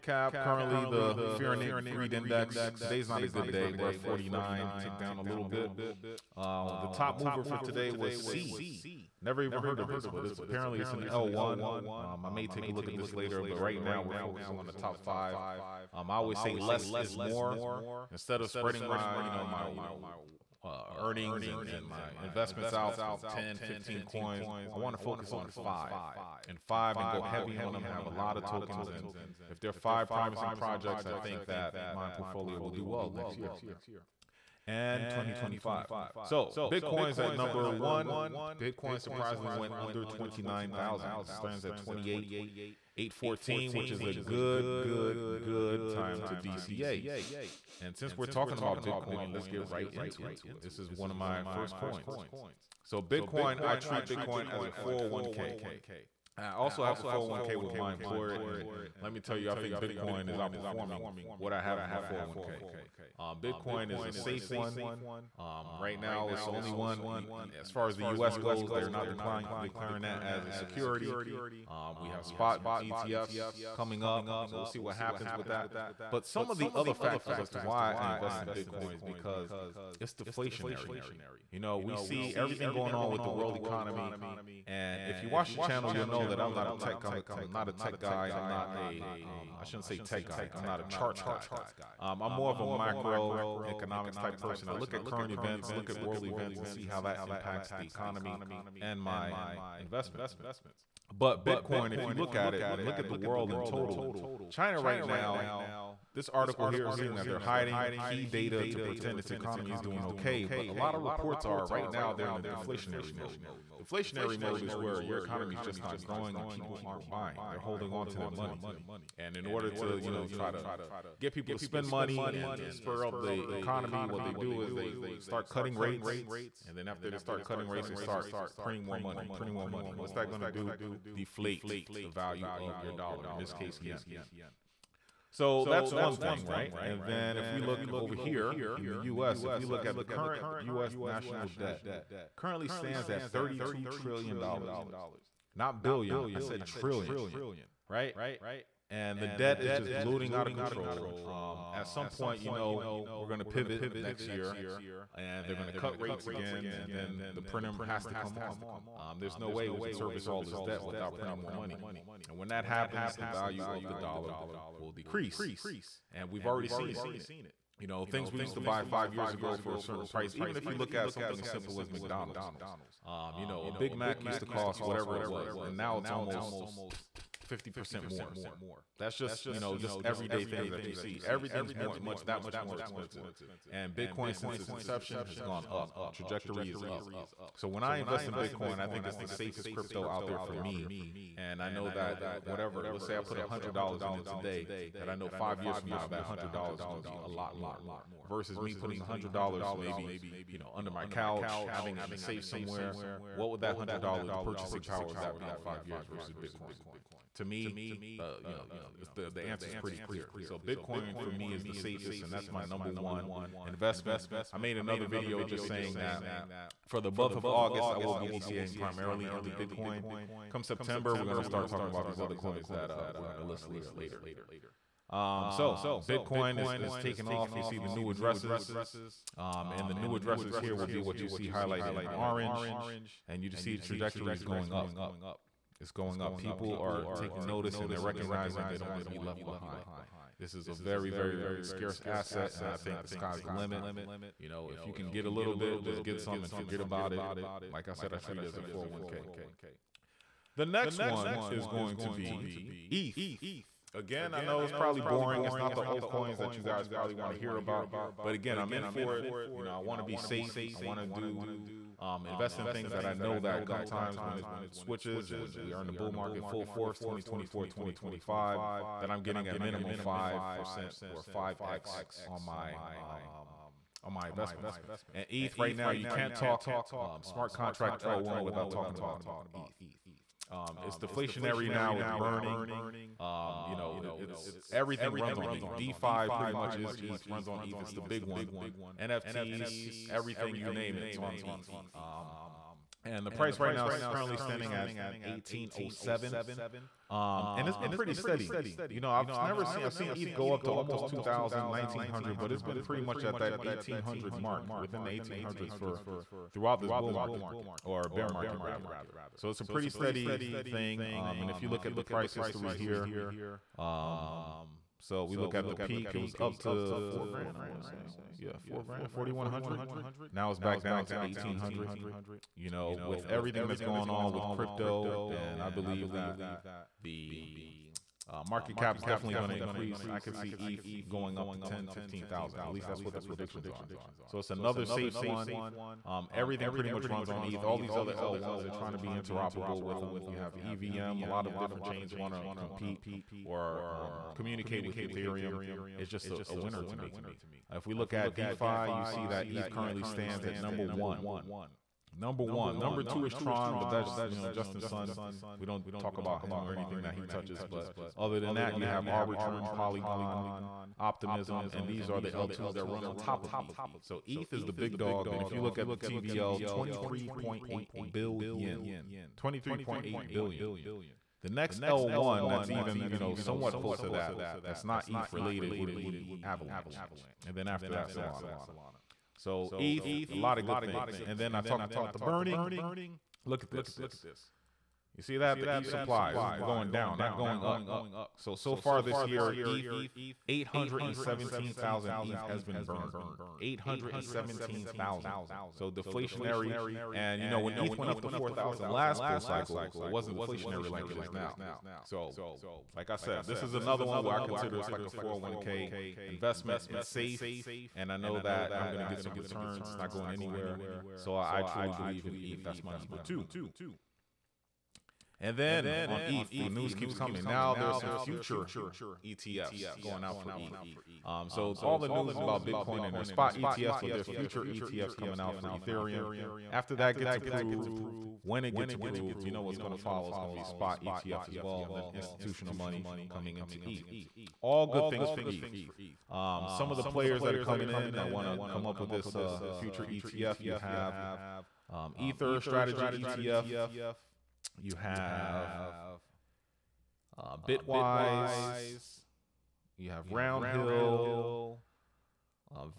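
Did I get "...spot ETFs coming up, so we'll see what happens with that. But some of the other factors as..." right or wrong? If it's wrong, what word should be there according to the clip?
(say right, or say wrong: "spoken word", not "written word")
right.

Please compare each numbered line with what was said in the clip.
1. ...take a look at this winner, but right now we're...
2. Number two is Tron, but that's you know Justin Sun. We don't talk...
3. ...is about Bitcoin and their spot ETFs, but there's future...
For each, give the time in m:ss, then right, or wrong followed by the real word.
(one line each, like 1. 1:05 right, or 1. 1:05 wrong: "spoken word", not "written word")
1. 0:12 wrong: "later", not "winner"
2. 5:52 right
3. 7:02 right.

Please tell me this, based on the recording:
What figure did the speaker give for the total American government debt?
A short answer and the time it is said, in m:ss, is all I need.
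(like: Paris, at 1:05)
$32 trillion, at 2:23.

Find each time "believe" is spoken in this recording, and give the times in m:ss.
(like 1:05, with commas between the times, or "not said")
5:25, 6:51.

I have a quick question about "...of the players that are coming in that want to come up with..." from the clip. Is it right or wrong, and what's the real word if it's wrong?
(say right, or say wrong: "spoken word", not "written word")
right.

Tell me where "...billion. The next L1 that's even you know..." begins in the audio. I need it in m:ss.
6:10.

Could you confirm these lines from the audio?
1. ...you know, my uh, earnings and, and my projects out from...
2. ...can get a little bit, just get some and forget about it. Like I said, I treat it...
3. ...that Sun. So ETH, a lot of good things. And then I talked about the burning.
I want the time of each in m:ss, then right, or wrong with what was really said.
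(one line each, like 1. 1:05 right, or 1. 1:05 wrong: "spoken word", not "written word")
1. 0:19 wrong: "investments", not "projects"
2. 4:04 right
3. 6:17 wrong: "Solana", not "Sun".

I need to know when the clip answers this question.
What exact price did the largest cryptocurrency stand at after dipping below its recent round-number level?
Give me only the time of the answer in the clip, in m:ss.
0:41.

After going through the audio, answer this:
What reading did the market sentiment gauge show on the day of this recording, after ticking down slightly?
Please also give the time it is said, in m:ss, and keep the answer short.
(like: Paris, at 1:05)
49, at 0:03.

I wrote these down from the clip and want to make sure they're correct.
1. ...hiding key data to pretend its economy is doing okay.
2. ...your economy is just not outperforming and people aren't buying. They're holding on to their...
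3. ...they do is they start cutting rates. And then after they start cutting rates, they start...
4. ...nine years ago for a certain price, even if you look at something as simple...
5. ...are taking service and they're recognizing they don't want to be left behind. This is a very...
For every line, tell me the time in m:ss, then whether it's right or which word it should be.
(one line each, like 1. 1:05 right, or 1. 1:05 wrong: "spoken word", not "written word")
1. 1:47 right
2. 1:55 wrong: "growing", not "outperforming"
3. 2:04 right
4. 2:48 wrong: "five", not "nine"
5. 3:56 wrong: "notice", not "service".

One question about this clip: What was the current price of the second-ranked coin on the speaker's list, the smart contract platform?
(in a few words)
1,807.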